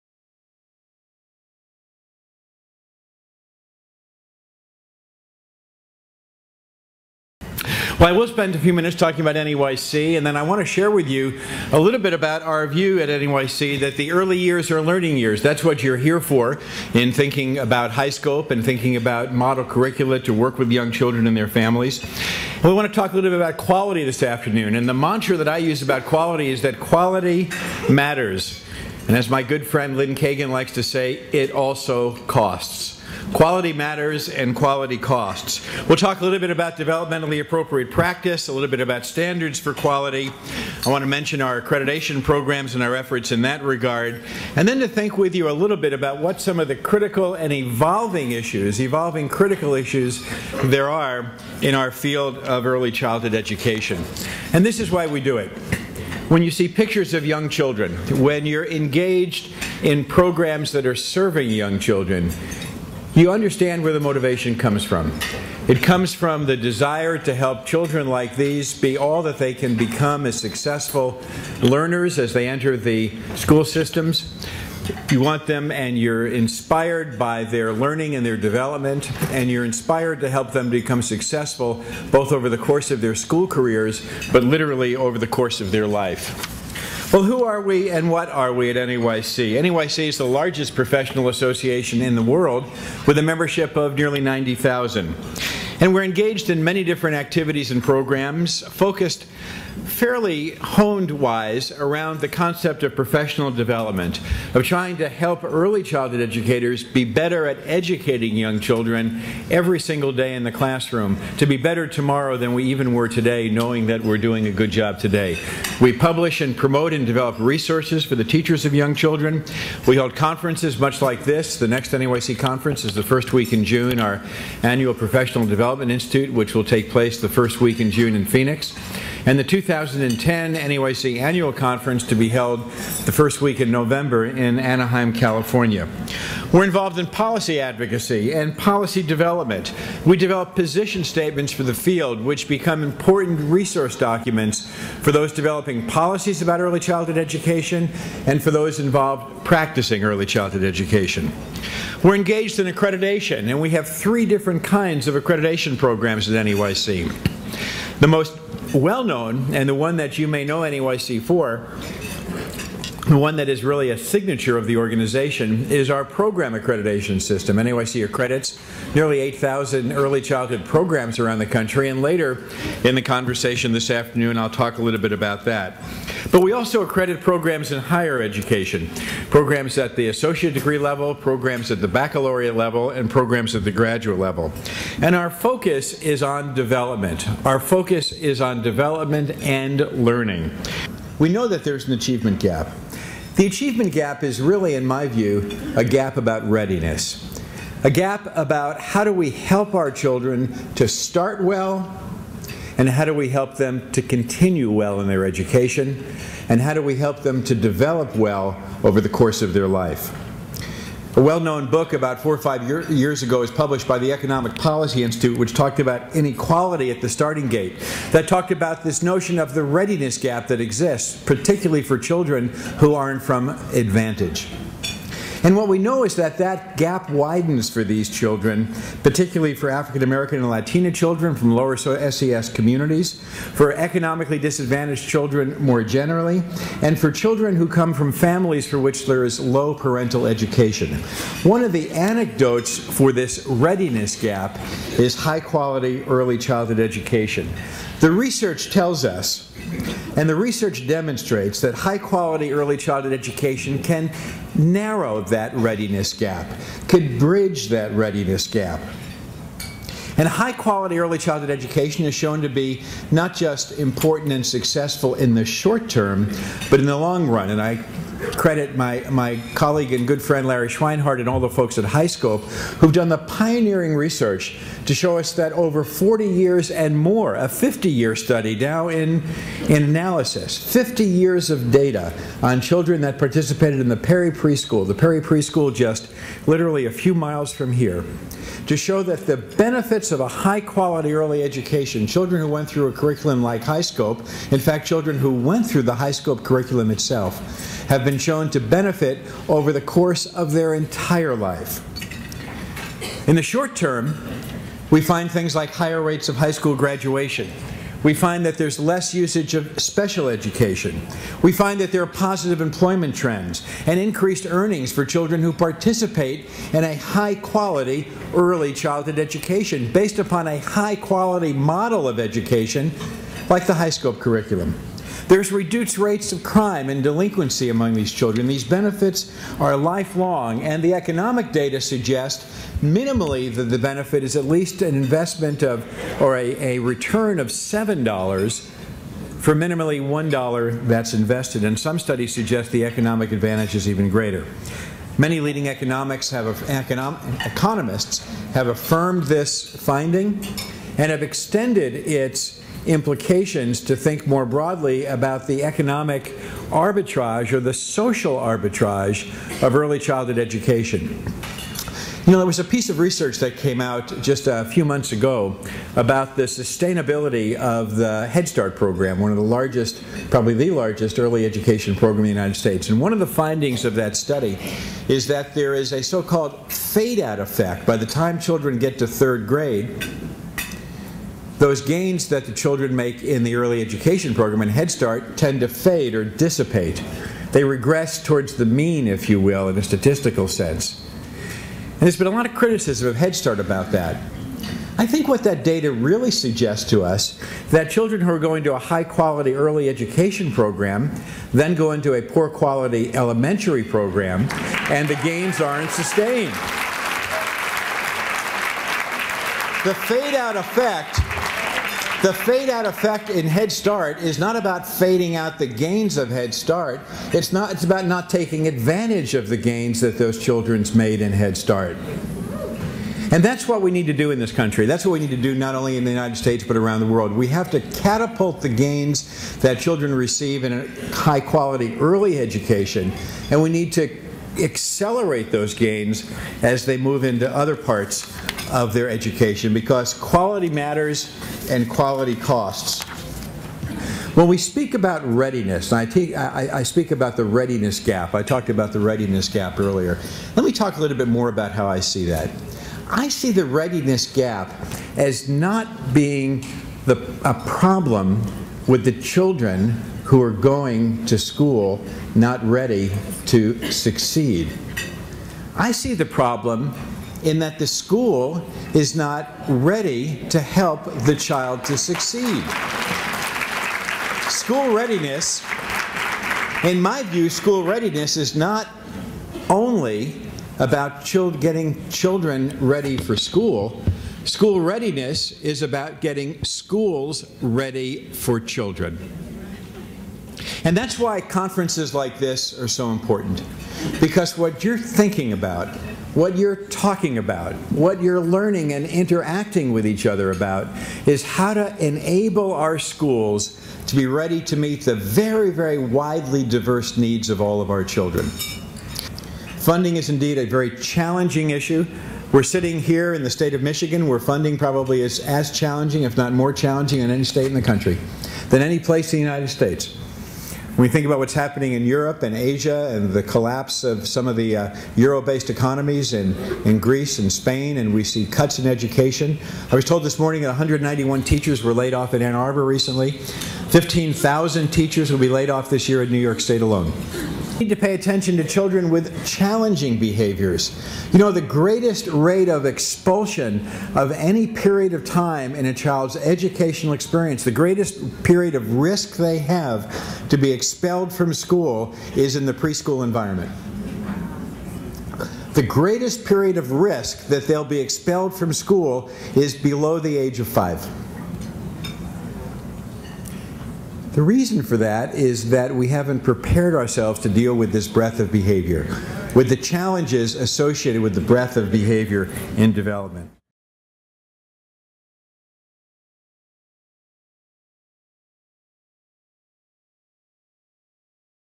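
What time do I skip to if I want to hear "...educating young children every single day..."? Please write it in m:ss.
1:47.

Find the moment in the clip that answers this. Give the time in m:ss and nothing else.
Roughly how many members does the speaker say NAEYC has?
1:33.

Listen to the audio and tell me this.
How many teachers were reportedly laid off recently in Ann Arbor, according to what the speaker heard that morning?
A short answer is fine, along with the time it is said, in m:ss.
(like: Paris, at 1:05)
191, at 8:50.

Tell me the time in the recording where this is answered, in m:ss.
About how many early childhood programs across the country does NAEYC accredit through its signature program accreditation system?
2:48.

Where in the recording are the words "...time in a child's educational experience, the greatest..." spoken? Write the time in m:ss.
9:05.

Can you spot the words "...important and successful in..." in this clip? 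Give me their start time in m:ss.
4:23.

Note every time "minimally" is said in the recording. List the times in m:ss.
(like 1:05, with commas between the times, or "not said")
5:32, 5:39.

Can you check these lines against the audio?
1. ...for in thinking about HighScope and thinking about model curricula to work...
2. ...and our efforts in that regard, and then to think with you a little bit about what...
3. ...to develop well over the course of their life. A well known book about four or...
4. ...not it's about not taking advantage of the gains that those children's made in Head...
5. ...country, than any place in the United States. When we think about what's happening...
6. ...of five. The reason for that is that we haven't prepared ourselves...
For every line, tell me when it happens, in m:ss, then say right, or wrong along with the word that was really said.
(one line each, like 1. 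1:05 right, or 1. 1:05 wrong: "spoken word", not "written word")
1. 0:16 right
2. 0:42 right
3. 3:27 right
4. 6:57 right
5. 8:37 right
6. 9:20 right.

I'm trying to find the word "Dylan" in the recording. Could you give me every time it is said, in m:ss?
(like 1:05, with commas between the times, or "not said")
not said.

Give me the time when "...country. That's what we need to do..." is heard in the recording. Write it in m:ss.
7:04.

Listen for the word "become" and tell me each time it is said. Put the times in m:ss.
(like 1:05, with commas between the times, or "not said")
1:09, 1:20, 2:22.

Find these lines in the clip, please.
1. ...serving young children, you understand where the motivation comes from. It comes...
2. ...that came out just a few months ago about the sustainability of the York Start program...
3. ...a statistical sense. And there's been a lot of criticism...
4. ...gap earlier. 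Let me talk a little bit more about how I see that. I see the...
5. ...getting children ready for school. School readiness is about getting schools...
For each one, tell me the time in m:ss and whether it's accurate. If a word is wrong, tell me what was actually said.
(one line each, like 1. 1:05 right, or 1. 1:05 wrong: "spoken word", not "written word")
1. 1:00 right
2. 6:03 wrong: "Head", not "York"
3. 6:29 right
4. 7:29 right
5. 8:01 right.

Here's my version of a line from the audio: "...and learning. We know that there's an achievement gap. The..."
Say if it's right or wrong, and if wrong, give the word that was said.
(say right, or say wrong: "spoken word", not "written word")
right.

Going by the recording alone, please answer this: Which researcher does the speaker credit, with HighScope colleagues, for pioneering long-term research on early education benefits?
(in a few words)
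Larry Schweinhart.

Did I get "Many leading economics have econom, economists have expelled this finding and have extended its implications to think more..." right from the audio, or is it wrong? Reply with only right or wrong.
wrong.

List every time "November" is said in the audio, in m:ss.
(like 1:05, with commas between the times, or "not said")
2:13.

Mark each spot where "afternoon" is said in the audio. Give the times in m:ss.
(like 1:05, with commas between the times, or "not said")
0:24, 2:53.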